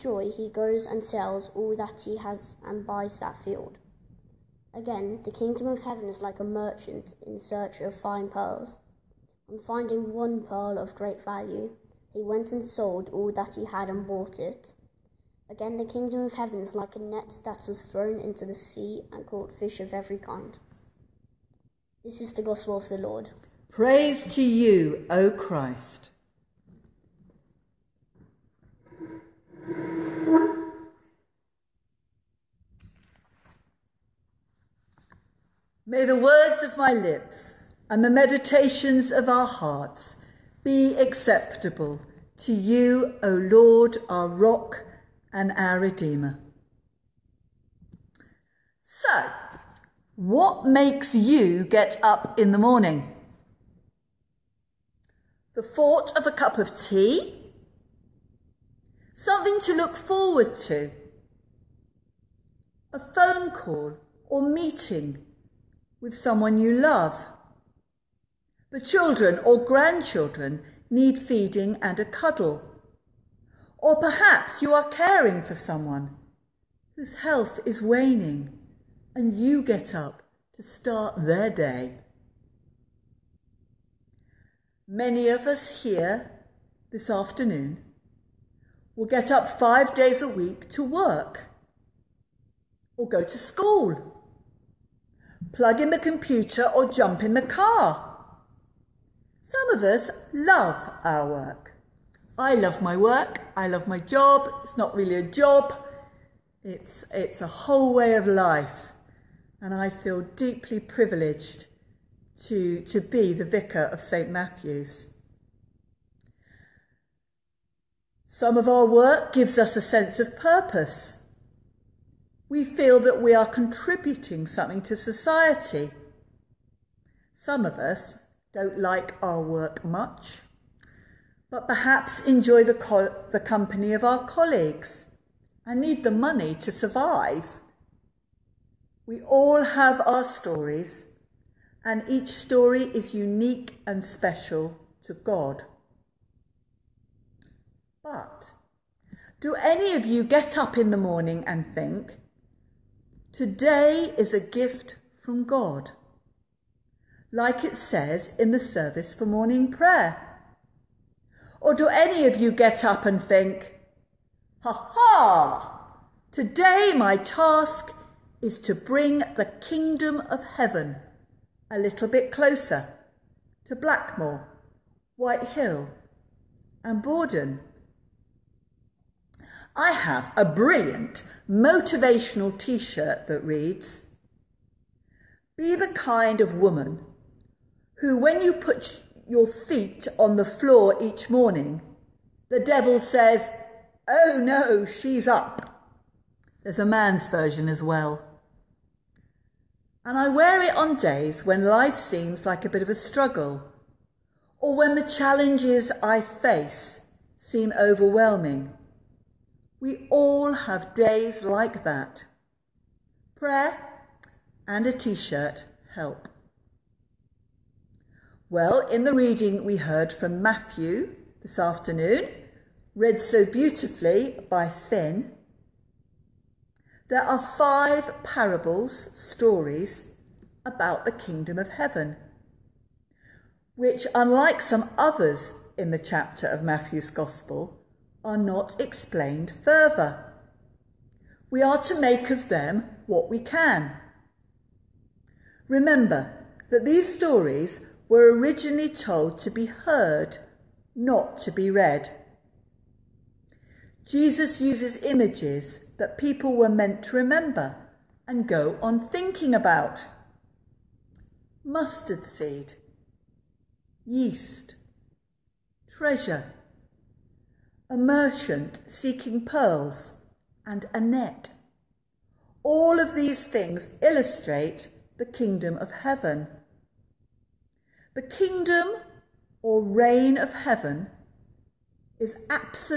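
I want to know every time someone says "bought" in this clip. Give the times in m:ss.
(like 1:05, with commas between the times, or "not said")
0:14.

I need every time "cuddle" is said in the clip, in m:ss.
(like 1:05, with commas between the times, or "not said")
1:12.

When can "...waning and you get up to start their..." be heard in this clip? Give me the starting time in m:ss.
1:17.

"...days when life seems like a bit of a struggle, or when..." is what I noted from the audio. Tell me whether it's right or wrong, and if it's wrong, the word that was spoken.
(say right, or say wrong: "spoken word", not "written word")
right.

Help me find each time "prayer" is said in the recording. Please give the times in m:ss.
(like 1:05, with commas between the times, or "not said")
2:39, 3:33.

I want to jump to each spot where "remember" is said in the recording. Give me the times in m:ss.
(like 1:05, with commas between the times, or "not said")
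4:05, 4:17.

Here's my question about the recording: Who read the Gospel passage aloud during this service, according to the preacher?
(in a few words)
Finn.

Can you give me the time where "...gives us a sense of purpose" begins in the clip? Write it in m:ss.
1:59.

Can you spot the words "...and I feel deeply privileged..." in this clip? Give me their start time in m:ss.
1:49.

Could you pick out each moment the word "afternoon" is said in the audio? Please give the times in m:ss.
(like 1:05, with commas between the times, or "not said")
1:27, 3:41.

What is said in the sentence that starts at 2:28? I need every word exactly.
But do any of you get up in the morning and think, today is a gift from God?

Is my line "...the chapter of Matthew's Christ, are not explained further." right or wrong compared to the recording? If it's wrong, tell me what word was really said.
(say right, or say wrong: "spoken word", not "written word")
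wrong: "Gospel", not "Christ".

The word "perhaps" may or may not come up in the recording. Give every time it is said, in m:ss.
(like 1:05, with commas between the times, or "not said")
1:14, 2:11.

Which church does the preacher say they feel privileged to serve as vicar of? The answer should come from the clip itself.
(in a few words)
St Matthew's.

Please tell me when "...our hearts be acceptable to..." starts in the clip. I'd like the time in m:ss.
0:39.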